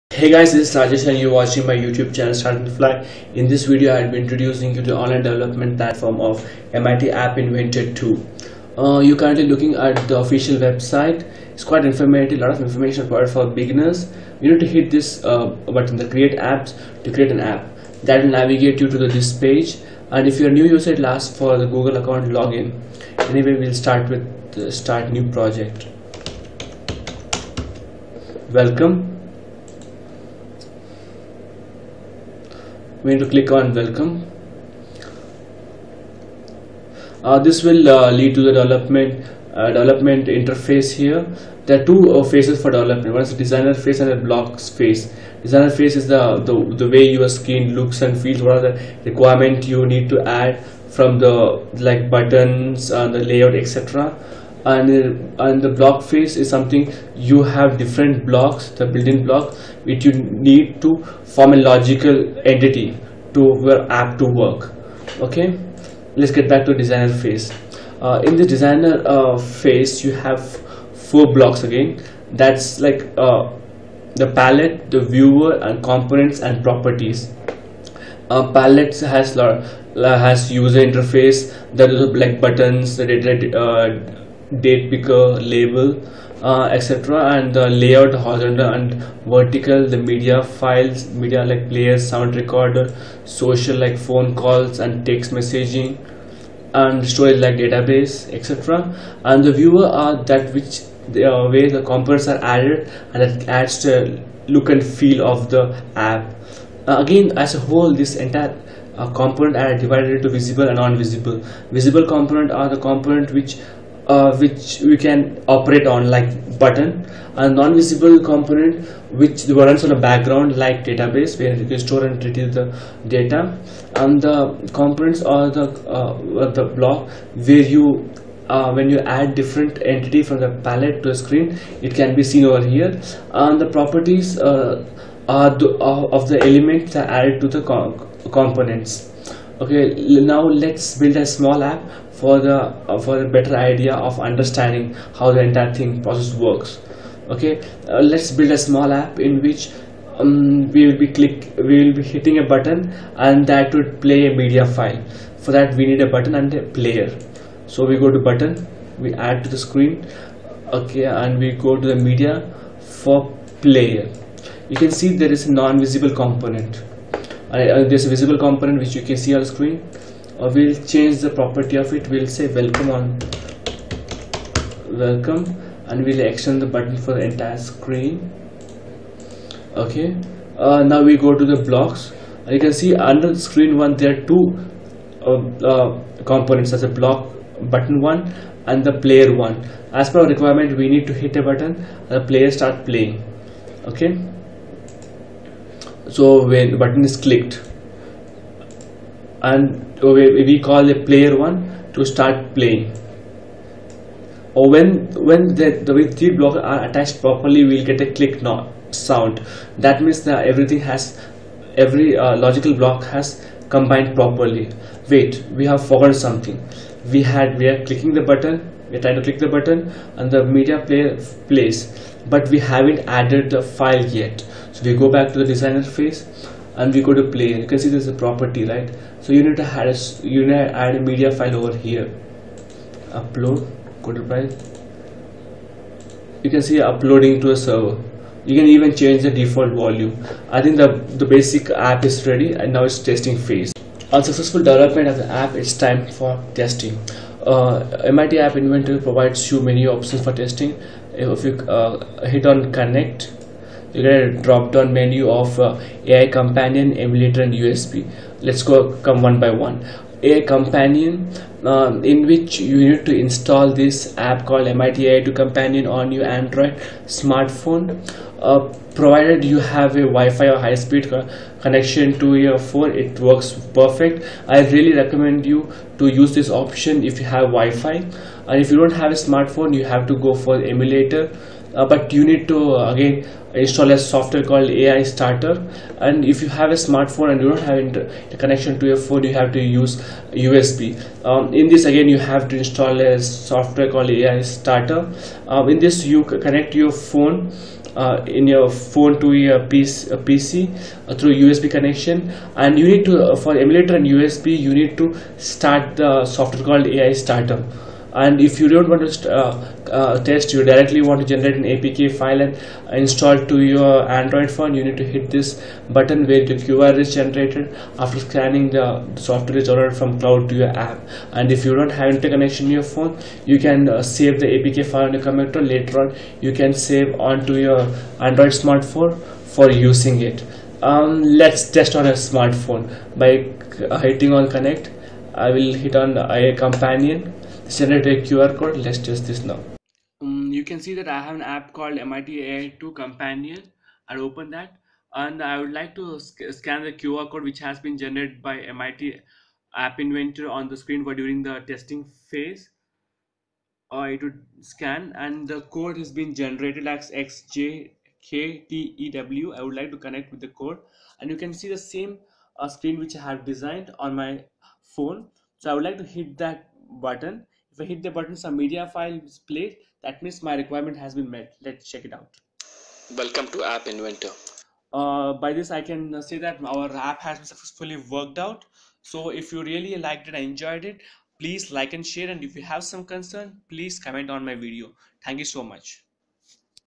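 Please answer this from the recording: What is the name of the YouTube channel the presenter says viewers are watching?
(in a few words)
Start and Fly.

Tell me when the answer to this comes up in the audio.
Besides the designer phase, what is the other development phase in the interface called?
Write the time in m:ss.
0:44.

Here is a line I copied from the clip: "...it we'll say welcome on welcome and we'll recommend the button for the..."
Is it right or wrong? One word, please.
wrong.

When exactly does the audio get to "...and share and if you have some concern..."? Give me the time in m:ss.
6:21.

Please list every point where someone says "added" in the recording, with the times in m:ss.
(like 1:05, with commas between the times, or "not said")
1:42, 2:17, 3:43.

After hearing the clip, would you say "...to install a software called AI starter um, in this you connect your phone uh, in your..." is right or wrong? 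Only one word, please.
right.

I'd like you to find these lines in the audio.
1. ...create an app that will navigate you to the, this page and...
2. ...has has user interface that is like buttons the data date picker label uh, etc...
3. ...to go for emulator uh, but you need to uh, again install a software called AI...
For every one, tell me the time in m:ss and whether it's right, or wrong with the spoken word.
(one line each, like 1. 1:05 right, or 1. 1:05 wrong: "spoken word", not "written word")
1. 0:17 right
2. 1:18 right
3. 4:40 right.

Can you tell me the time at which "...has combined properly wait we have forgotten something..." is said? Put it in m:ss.
3:33.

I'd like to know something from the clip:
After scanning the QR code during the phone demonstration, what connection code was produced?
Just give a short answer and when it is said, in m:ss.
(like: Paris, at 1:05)
XJKTEW, at 5:57.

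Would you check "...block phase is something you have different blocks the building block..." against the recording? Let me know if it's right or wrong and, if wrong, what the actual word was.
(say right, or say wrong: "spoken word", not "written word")
right.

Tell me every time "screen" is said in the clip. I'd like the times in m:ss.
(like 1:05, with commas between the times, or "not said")
0:47, 2:11, 2:39, 2:49, 2:57, 3:03, 5:50, 6:02.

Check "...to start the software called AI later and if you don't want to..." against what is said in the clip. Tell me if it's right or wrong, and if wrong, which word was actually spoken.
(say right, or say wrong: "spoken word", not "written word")
wrong: "starter", not "later".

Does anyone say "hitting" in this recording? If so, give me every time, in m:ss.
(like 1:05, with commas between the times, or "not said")
2:32, 5:34.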